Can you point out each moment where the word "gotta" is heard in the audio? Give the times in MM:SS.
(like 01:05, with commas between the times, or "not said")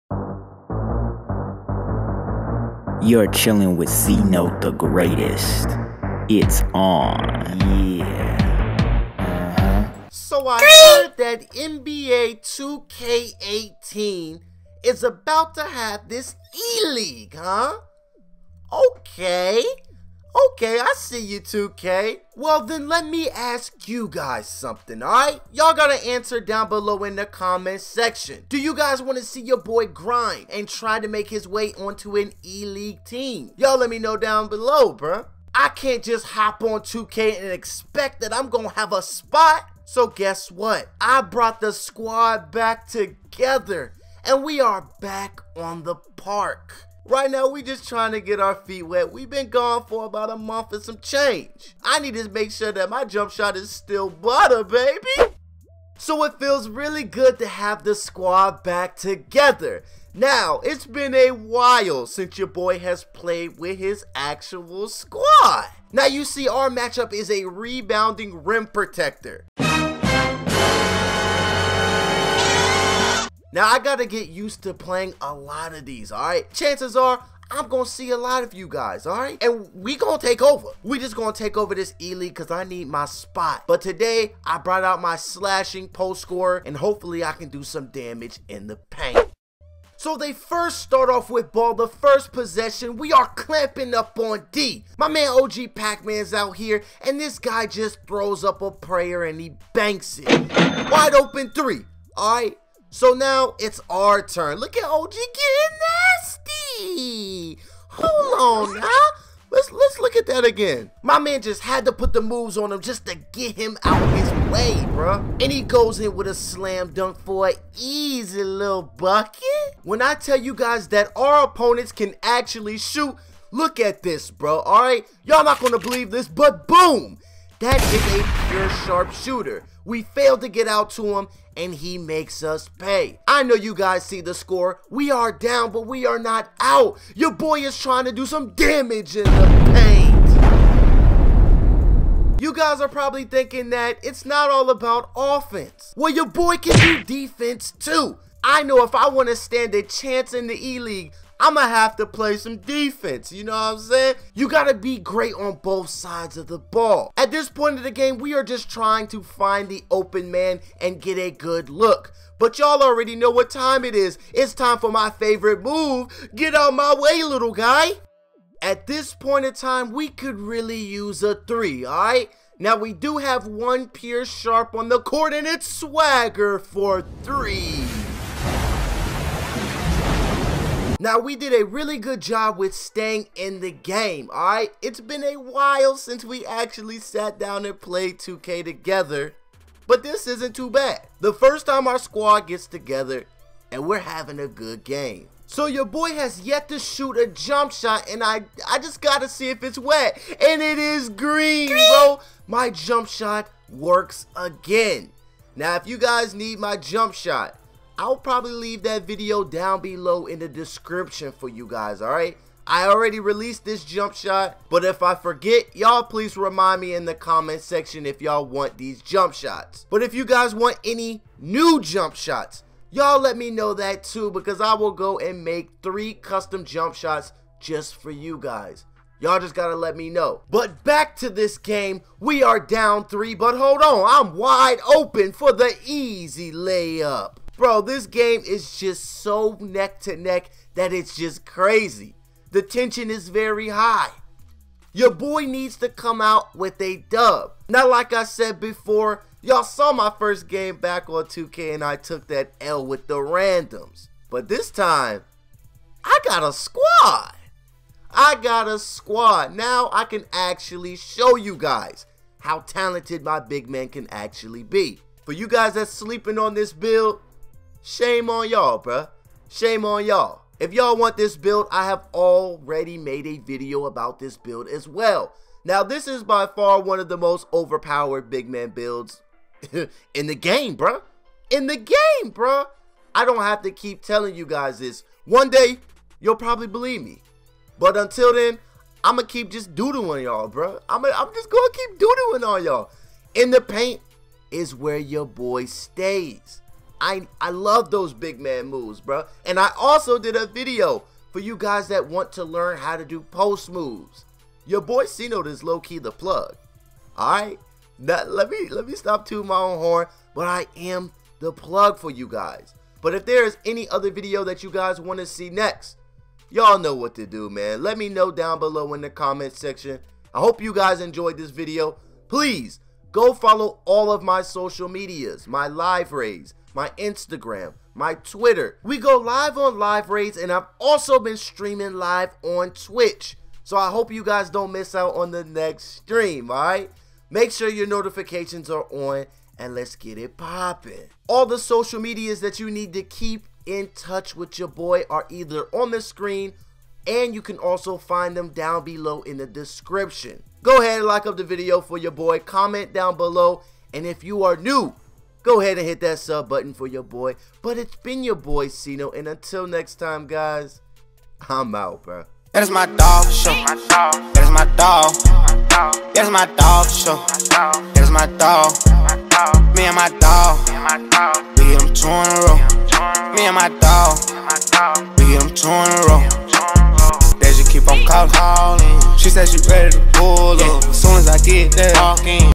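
00:25, 03:19, 03:49.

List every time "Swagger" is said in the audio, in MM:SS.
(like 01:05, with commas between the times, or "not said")
02:55.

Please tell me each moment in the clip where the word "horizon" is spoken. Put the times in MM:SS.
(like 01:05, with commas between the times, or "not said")
not said.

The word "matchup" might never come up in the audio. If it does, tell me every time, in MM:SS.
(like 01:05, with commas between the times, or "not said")
01:06.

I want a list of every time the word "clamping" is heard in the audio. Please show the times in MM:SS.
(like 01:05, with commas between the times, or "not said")
01:33.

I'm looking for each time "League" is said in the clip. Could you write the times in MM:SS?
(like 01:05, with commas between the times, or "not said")
00:16, 00:32, 01:21, 02:30.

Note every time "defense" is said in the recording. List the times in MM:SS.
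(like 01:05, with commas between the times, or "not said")
02:27, 02:32.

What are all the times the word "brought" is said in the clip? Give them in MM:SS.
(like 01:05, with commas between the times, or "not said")
00:41, 01:24.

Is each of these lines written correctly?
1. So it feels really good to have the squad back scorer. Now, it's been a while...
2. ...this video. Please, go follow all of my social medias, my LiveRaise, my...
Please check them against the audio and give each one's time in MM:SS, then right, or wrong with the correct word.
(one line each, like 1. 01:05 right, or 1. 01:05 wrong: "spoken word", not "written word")
1. 00:55 wrong: "together", not "scorer"
2. 05:21 right.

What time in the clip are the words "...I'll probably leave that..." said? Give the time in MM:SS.
03:28.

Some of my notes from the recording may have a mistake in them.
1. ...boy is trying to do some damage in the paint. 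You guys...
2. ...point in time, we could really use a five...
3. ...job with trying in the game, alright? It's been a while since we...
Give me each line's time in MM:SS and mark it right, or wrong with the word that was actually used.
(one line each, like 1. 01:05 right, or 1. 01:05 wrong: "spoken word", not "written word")
1. 02:17 right
2. 02:49 wrong: "three", not "five"
3. 03:02 wrong: "staying", not "trying".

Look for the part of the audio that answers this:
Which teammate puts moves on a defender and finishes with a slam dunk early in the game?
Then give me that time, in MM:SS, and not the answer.
01:35.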